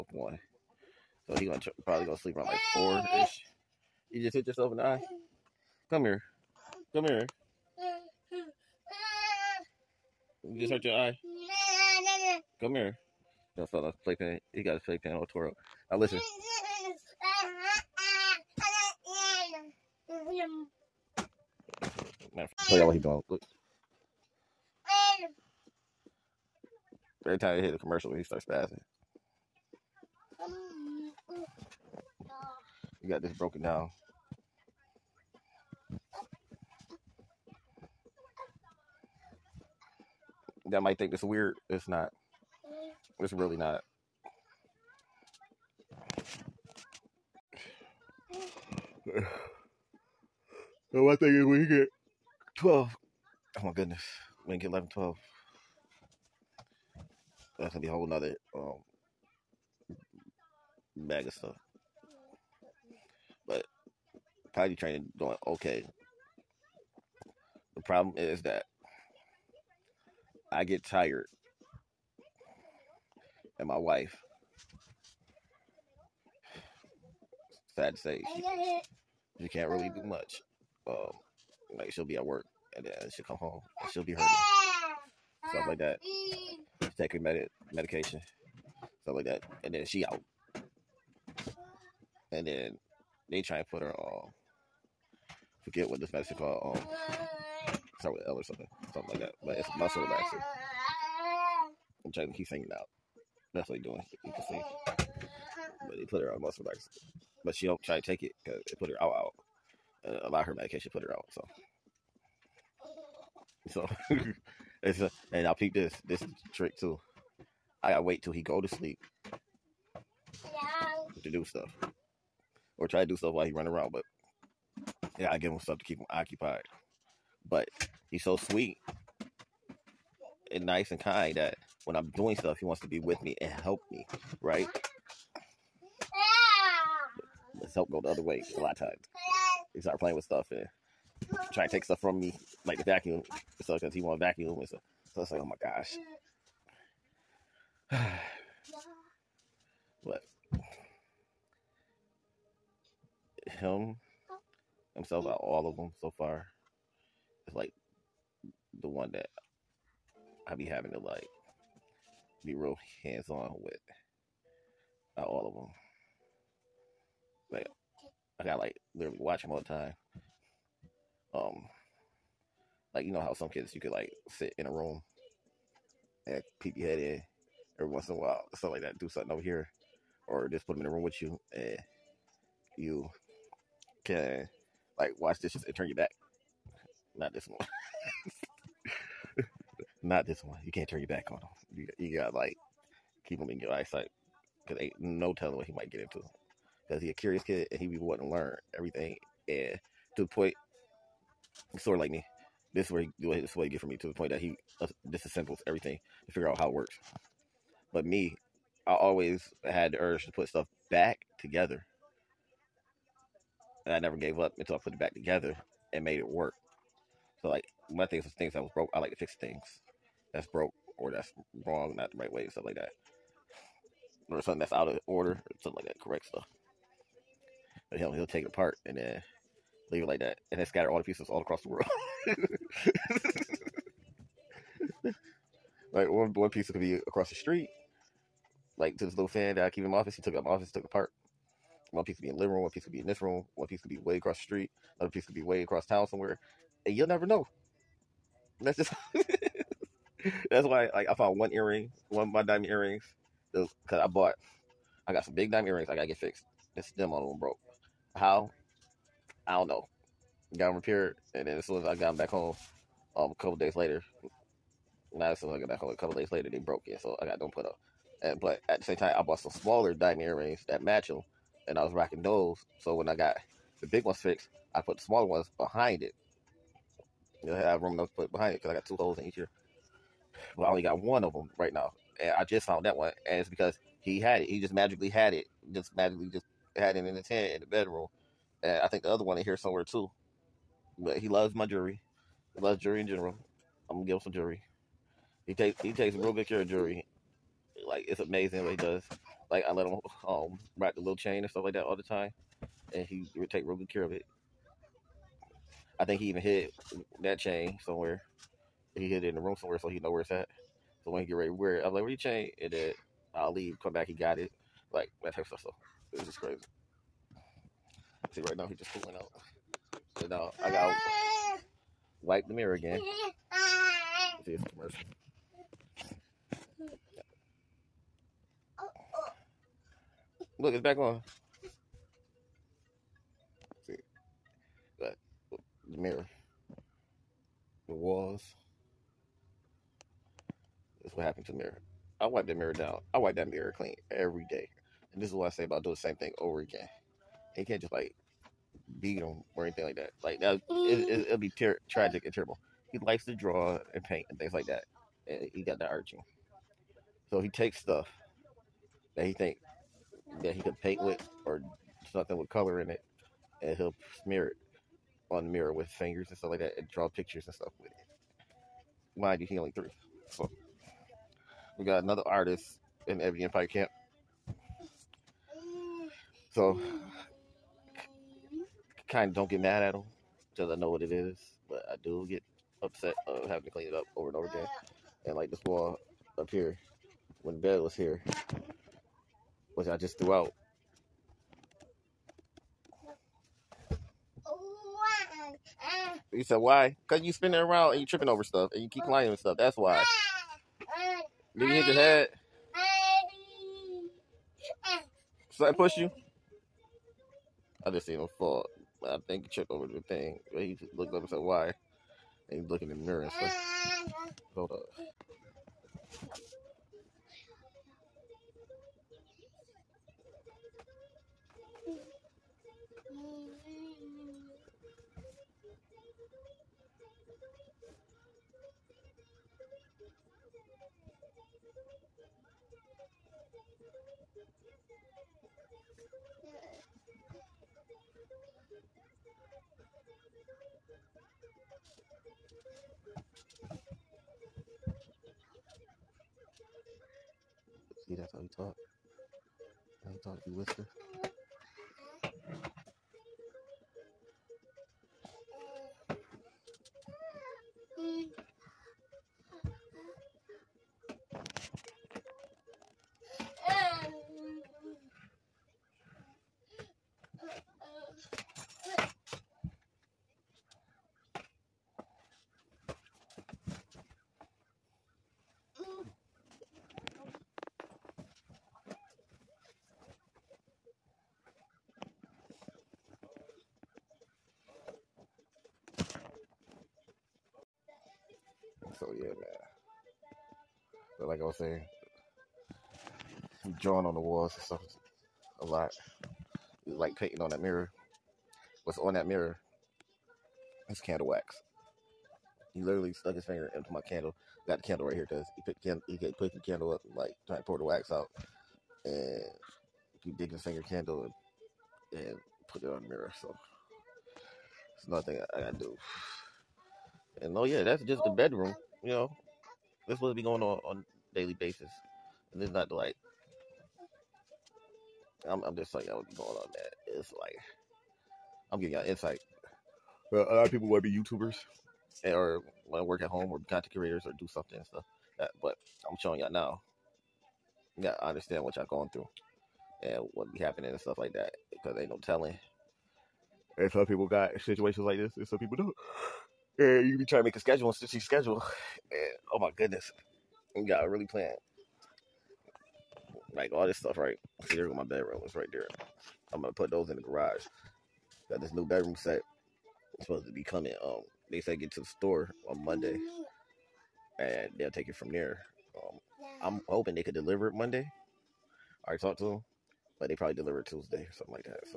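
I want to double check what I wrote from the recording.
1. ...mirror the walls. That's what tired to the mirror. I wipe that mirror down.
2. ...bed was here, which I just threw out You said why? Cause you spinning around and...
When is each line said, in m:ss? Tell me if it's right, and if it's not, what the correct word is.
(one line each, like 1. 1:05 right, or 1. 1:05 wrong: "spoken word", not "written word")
1. 5:35 wrong: "happened", not "tired"
2. 6:27 right.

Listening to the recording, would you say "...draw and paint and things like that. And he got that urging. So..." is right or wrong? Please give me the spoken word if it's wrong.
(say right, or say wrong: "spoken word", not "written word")
right.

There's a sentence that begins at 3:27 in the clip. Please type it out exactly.
But me, I always had the urge to put stuff back together.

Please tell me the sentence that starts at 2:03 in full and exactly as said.
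But yeah, I give him stuff to keep him occupied.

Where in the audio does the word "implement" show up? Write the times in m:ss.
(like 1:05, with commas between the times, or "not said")
not said.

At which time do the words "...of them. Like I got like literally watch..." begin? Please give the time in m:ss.
2:45.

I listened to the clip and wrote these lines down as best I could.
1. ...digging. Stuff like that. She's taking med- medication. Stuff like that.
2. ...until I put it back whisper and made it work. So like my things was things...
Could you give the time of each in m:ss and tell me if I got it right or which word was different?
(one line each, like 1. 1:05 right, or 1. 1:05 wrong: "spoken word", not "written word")
1. 1:24 wrong: "hurting", not "digging"
2. 3:34 wrong: "together", not "whisper".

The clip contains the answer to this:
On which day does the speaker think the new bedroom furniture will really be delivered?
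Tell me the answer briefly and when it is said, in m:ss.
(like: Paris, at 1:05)
Tuesday, at 9:30.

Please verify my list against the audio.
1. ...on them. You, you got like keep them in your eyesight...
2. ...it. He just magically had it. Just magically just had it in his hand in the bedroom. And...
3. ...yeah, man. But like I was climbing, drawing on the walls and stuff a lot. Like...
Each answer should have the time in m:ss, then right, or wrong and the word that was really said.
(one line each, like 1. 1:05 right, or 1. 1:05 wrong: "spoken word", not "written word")
1. 3:11 right
2. 4:44 right
3. 8:09 wrong: "saying", not "climbing".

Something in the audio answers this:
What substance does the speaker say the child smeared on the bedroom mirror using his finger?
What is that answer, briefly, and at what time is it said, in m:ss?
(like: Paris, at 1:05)
Candle wax, at 8:20.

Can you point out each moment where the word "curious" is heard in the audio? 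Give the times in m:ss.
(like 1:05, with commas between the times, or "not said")
3:17.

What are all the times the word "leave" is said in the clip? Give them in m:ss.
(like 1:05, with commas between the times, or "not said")
3:49, 5:13.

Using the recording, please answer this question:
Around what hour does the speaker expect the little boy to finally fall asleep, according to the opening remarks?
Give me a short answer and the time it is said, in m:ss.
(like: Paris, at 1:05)
4, at 0:02.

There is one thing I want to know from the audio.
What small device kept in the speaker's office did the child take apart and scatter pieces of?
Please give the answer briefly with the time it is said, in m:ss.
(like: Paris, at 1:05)
Fan, at 3:59.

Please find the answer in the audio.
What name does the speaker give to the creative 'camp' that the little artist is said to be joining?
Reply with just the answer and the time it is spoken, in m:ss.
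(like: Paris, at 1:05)
Ebony Empire, at 6:13.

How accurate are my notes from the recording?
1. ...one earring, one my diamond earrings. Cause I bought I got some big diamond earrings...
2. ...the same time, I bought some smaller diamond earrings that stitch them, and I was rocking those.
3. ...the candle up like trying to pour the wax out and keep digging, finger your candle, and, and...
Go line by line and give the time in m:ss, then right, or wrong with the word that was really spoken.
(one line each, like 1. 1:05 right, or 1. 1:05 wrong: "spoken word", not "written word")
1. 4:11 right
2. 4:28 wrong: "match", not "stitch"
3. 8:26 right.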